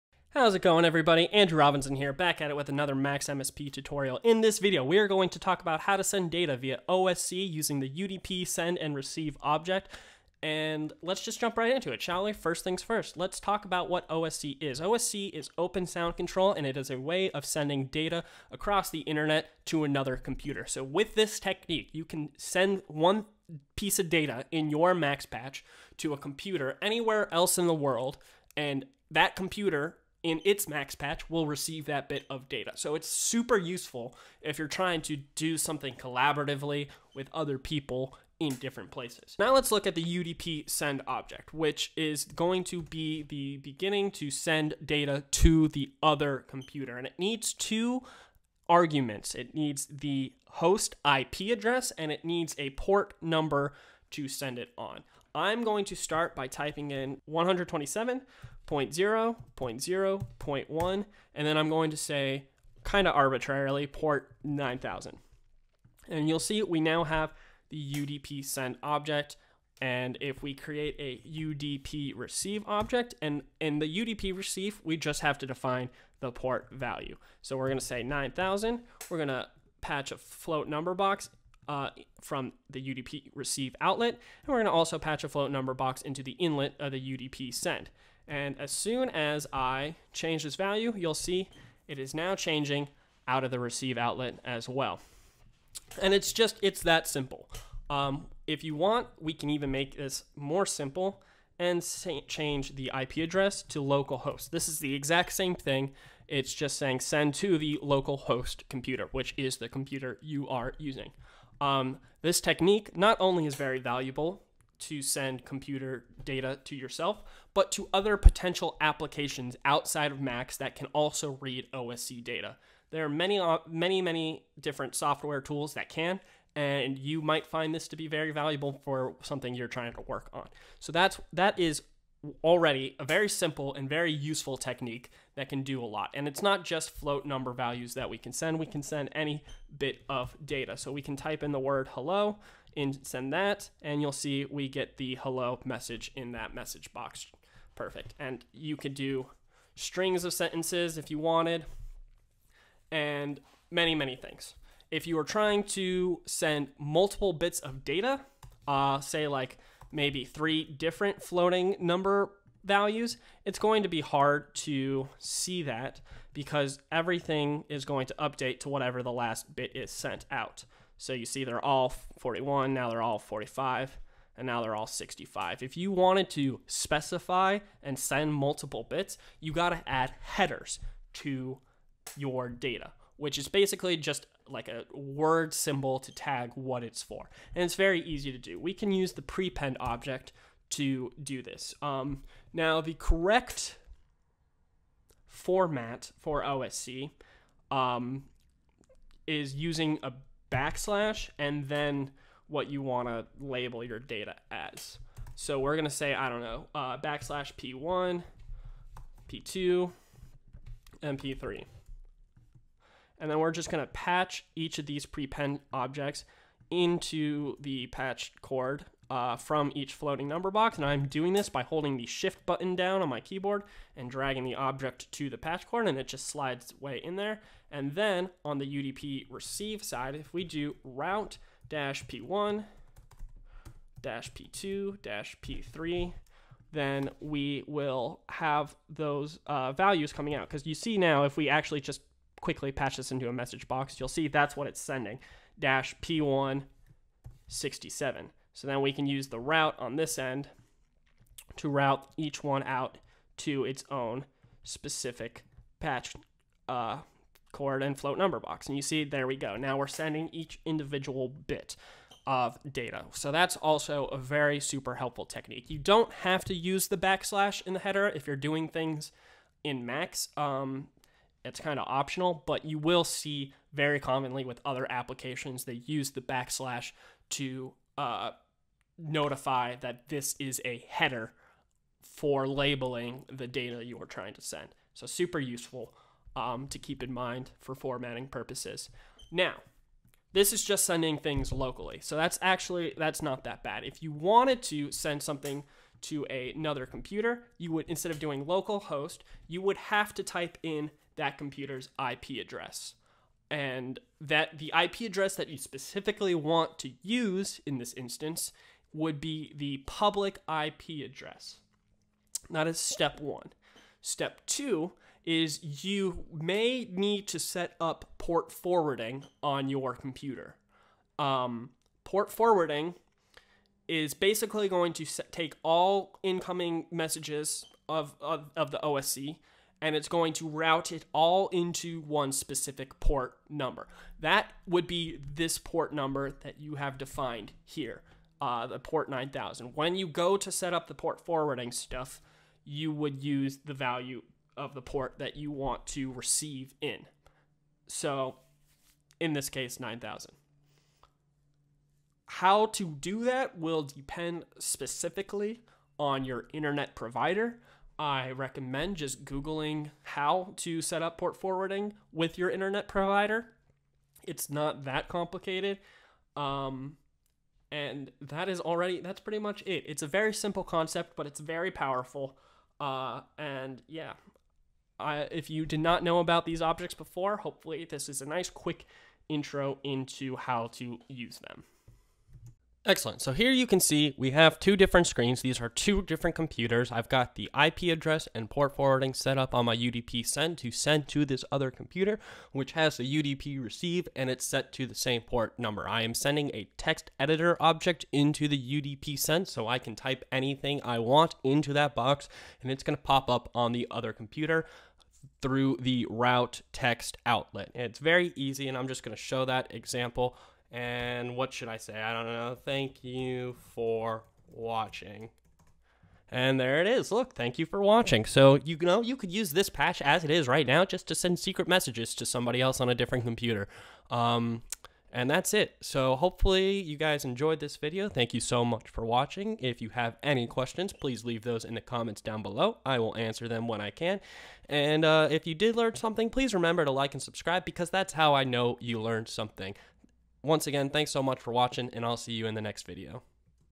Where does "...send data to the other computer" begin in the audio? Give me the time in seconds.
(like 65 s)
44 s.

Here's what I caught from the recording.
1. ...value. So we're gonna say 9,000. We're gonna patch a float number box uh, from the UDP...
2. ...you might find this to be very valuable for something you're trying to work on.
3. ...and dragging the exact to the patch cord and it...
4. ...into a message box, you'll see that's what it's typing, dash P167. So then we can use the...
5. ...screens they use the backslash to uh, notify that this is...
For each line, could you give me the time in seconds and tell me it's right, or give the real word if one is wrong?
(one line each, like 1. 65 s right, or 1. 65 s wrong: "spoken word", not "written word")
1. 76 s right
2. 126 s right
3. 223 s wrong: "object", not "exact"
4. 243 s wrong: "sending", not "typing"
5. 274 s wrong: "applications", not "screens".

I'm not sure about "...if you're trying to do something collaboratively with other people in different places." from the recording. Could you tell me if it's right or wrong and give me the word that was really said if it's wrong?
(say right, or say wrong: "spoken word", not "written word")
right.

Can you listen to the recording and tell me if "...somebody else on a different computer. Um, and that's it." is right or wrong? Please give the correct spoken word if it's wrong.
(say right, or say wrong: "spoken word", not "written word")
right.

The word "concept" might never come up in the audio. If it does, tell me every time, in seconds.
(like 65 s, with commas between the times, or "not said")
370 s.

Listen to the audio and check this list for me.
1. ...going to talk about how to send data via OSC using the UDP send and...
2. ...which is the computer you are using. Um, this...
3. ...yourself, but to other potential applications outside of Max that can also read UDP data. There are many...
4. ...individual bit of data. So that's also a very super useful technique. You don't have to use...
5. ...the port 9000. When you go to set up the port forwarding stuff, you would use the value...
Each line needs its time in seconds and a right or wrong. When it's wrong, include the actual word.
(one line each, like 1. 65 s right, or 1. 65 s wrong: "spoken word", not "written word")
1. 5 s right
2. 109 s right
3. 116 s wrong: "OSC", not "UDP"
4. 260 s wrong: "helpful", not "useful"
5. 338 s right.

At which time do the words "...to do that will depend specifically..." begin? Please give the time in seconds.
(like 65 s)
352 s.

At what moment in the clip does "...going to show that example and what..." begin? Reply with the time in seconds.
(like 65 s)
409 s.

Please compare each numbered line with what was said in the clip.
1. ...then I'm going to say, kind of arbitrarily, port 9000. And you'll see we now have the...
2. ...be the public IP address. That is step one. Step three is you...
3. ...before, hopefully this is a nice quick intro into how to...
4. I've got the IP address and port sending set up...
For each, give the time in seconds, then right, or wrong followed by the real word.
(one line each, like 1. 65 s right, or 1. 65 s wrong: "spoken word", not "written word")
1. 61 s right
2. 309 s wrong: "two", not "three"
3. 376 s right
4. 386 s wrong: "forwarding", not "sending".